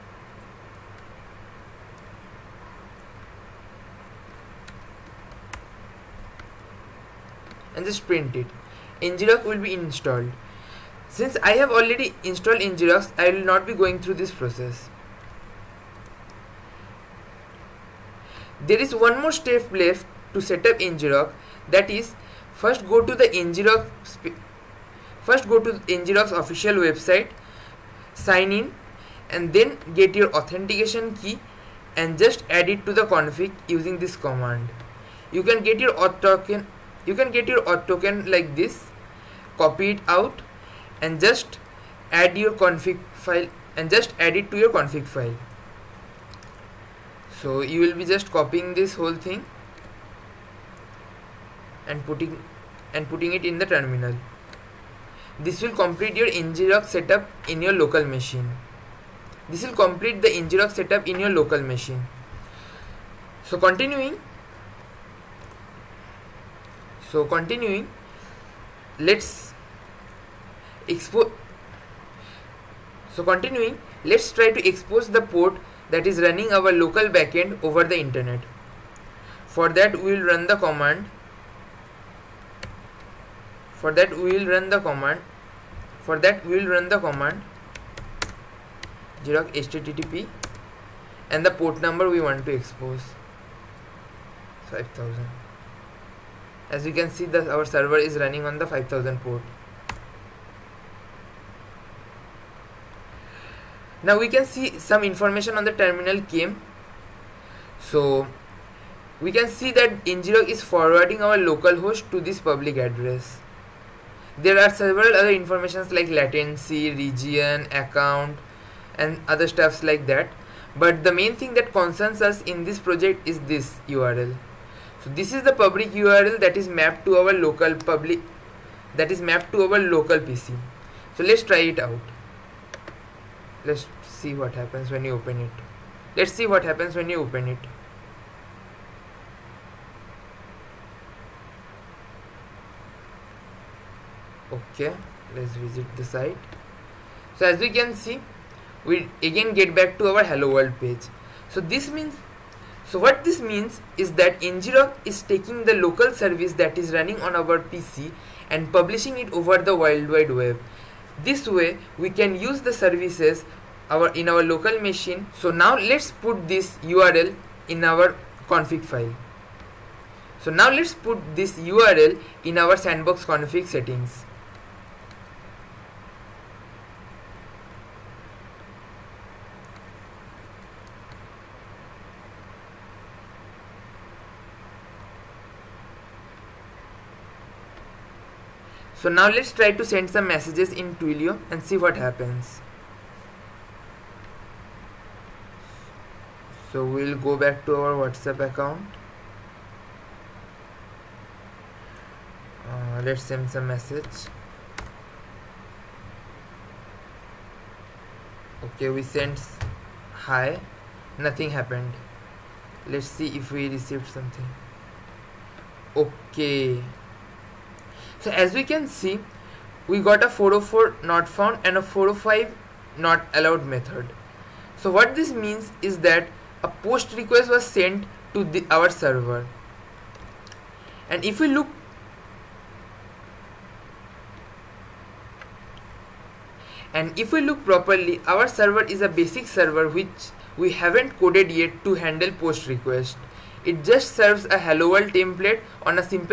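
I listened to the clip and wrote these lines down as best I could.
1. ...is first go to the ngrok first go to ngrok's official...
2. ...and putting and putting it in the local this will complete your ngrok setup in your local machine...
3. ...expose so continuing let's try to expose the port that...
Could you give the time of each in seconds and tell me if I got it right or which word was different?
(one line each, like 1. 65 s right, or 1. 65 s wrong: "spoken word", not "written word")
1. 21 s right
2. 51 s wrong: "terminal", not "local"
3. 70 s right.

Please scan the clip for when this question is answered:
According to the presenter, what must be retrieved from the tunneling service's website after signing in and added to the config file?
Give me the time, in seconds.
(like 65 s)
30 s.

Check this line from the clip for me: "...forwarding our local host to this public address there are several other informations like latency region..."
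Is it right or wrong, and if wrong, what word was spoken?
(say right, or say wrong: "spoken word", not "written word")
right.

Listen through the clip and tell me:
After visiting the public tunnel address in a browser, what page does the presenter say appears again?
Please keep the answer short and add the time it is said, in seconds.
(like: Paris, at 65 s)
hello world page, at 150 s.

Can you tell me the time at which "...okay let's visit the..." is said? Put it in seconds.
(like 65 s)
144 s.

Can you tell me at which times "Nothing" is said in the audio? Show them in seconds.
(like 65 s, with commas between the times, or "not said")
211 s.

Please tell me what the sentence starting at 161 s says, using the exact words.
This way we can use the services our in our local machine.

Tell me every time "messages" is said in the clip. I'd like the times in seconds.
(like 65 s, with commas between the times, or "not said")
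190 s, 203 s.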